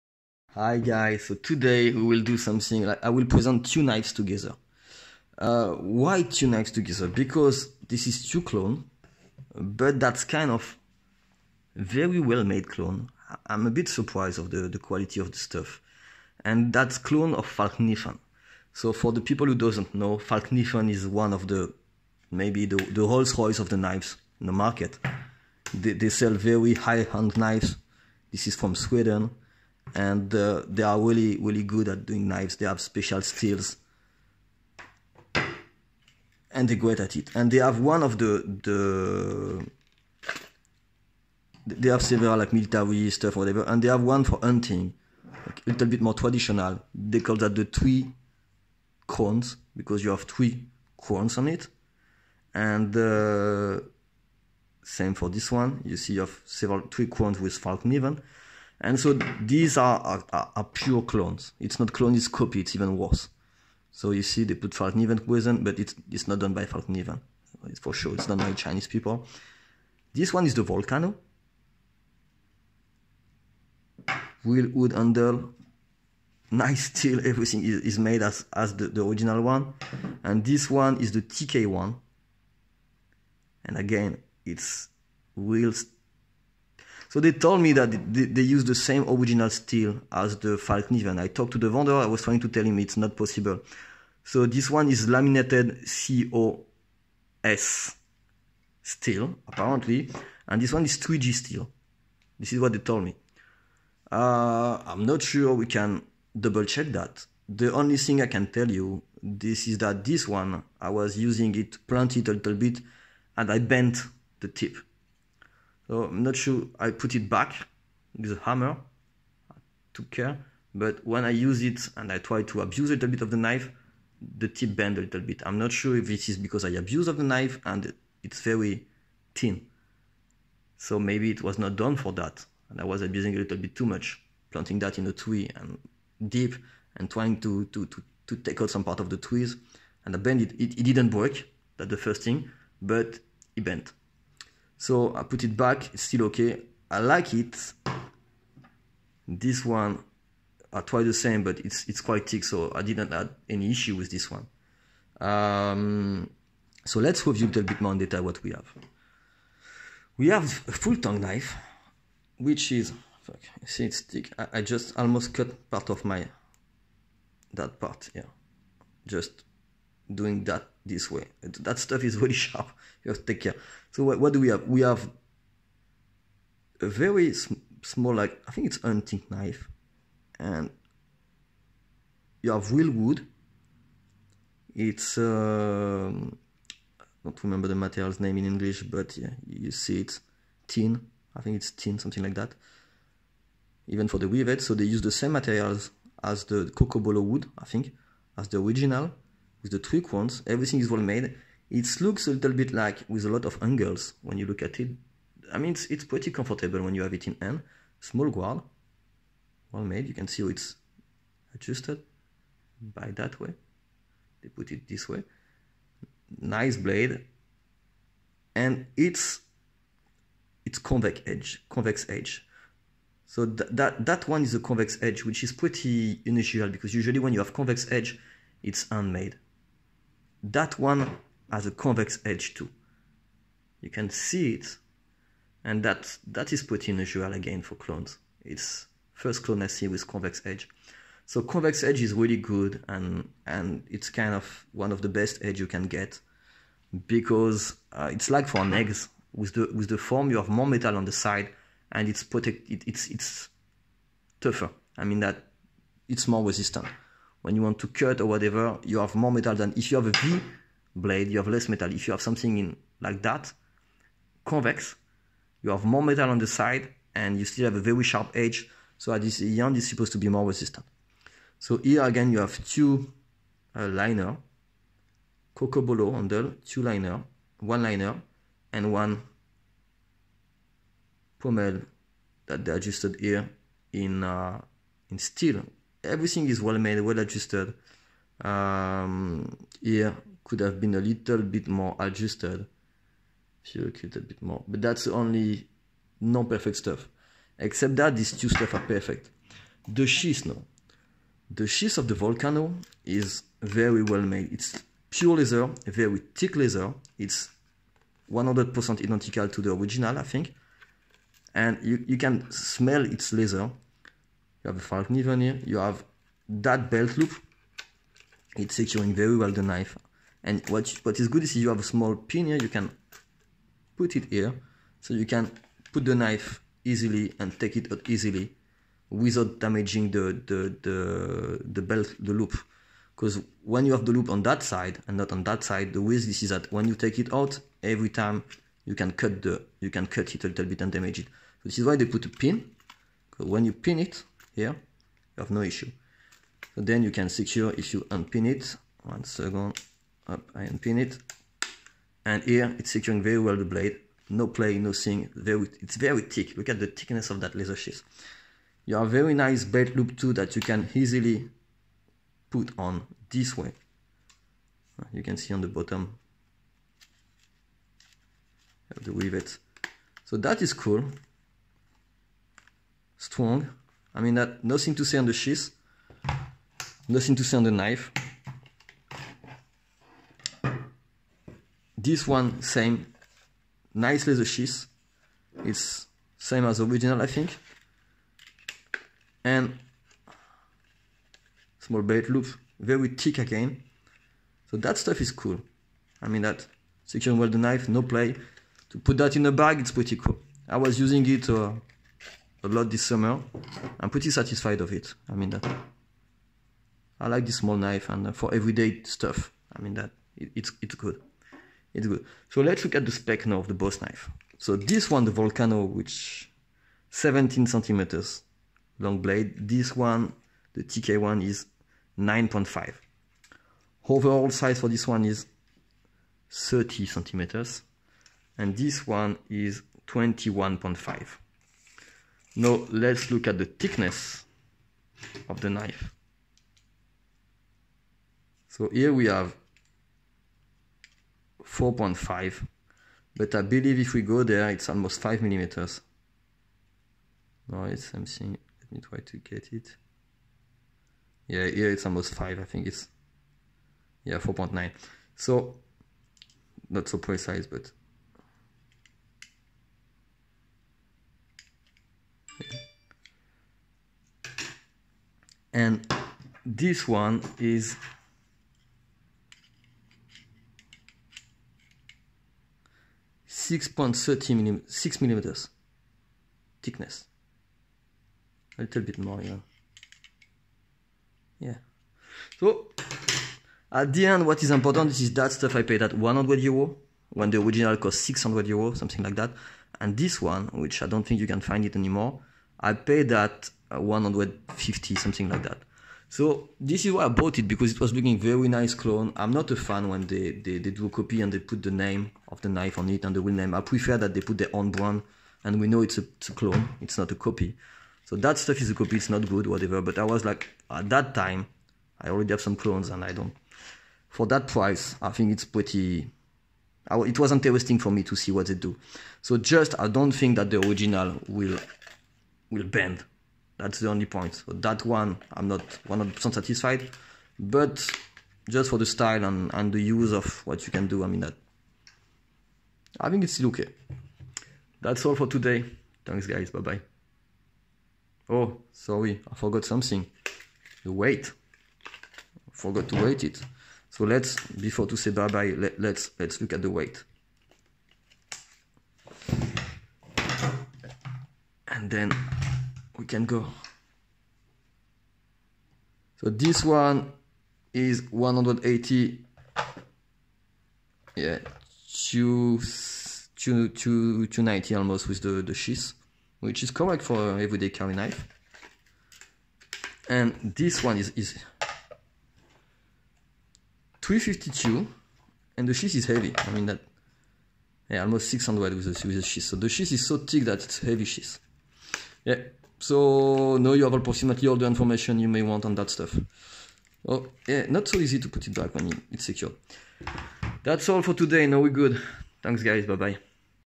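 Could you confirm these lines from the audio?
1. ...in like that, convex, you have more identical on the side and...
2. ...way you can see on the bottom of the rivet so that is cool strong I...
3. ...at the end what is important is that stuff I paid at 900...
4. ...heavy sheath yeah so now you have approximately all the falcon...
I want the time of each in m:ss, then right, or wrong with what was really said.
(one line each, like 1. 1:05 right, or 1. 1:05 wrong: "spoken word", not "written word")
1. 4:22 wrong: "metal", not "identical"
2. 6:03 right
3. 8:03 wrong: "100", not "900"
4. 9:40 wrong: "information", not "falcon".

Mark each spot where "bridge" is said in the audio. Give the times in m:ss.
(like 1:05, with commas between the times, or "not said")
not said.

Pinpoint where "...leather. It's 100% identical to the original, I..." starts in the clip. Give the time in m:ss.
5:06.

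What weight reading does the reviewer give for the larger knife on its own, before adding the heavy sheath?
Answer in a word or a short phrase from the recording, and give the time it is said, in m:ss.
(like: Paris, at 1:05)
352, at 9:34.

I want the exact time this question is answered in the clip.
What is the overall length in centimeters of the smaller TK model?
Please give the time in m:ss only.
7:10.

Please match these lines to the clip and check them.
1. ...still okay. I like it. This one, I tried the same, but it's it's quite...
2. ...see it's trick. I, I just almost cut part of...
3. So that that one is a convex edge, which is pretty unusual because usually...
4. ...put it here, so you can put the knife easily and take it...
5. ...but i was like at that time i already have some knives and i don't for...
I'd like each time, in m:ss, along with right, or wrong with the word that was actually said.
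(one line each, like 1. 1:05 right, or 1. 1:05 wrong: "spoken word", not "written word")
1. 2:26 right
2. 2:43 wrong: "thick", not "trick"
3. 3:43 right
4. 5:23 right
5. 8:30 wrong: "clones", not "knives".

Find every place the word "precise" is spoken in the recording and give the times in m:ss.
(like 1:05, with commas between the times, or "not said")
7:37.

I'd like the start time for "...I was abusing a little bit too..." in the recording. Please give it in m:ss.
2:12.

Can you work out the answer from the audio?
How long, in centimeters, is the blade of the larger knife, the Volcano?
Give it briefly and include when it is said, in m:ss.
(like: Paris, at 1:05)
17 centimeters, at 6:57.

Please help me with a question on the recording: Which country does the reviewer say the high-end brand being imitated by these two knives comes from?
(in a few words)
Sweden.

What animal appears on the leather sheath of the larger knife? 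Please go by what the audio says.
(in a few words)
falcon.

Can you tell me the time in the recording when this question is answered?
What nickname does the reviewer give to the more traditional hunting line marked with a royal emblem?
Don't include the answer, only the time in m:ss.
0:47.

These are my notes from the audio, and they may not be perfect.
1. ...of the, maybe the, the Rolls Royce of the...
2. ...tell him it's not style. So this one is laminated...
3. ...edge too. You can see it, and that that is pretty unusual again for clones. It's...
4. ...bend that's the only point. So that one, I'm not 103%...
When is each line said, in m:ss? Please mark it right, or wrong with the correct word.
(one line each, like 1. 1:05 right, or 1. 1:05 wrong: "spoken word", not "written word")
1. 0:21 right
2. 1:32 wrong: "possible", not "style"
3. 3:52 right
4. 8:42 wrong: "100", not "103".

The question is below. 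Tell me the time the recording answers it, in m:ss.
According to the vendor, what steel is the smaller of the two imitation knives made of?
1:40.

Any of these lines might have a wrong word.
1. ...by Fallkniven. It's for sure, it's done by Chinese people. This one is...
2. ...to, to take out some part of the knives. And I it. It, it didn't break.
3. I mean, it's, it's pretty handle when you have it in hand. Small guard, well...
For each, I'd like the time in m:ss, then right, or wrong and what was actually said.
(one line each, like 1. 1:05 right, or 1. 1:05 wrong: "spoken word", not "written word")
1. 1:06 right
2. 2:17 wrong: "trees", not "knives"
3. 3:25 wrong: "comfortable", not "handle".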